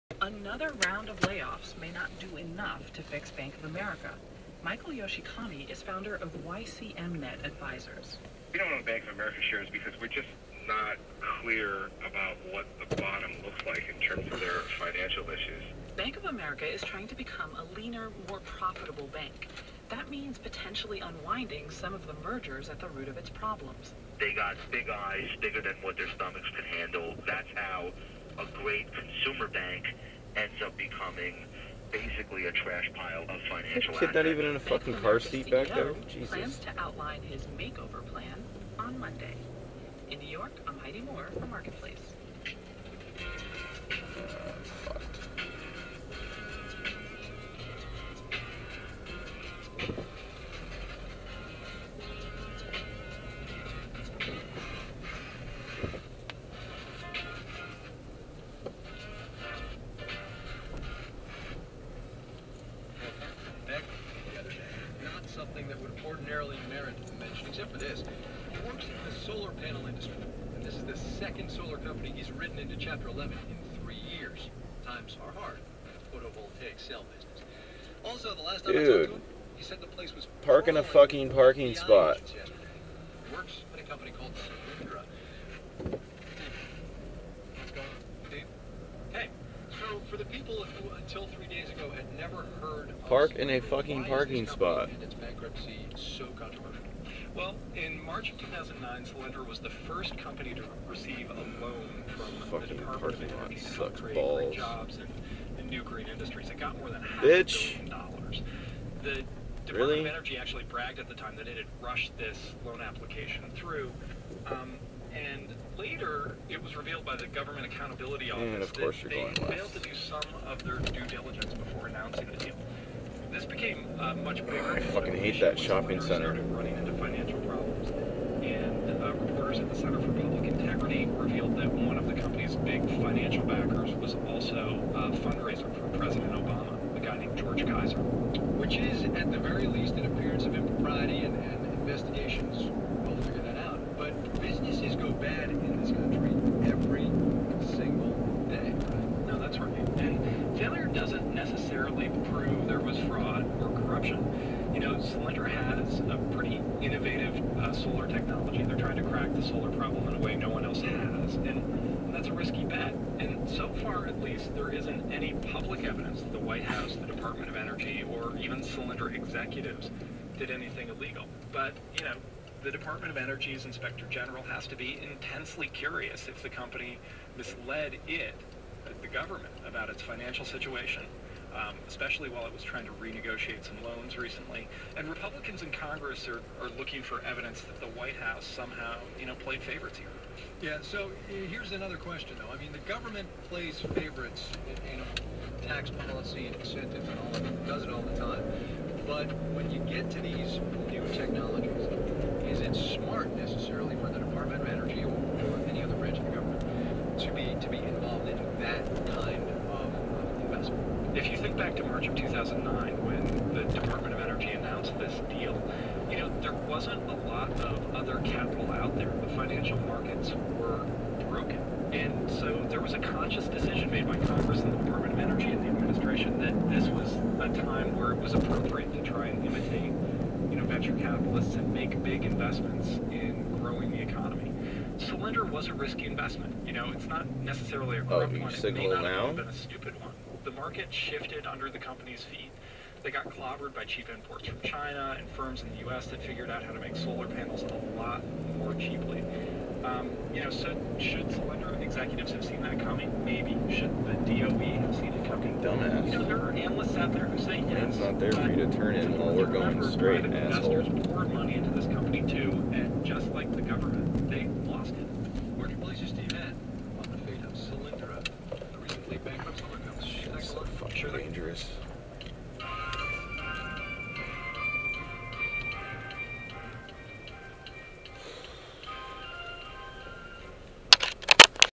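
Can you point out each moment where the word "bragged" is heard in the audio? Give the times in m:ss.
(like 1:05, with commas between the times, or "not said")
1:50.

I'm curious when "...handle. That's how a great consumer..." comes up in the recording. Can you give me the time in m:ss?
0:26.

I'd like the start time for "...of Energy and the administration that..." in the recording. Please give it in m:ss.
3:45.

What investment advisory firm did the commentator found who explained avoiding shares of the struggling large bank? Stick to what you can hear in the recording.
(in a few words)
YCMNet Advisors.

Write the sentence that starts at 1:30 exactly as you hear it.
for the people who until three days ago had never heard Park in a fucking parking spot.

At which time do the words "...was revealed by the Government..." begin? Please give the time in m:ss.
1:56.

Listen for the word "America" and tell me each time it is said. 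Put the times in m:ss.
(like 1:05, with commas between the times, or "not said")
0:03, 0:09, 0:16.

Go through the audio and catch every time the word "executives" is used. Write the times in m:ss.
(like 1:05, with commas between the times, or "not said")
2:49, 4:11.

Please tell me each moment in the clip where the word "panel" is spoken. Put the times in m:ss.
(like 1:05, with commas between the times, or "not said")
1:09, 4:07.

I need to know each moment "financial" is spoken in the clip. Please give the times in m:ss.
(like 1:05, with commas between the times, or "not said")
0:14, 0:33, 2:06, 2:13, 3:00, 3:39.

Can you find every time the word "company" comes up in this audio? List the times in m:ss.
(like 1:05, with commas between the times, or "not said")
1:11, 1:23, 1:40, 2:12, 2:56, 4:01, 4:21.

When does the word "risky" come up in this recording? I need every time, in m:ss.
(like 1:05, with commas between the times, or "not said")
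2:42, 3:55.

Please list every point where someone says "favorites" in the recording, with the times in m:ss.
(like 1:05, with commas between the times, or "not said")
3:09, 3:13.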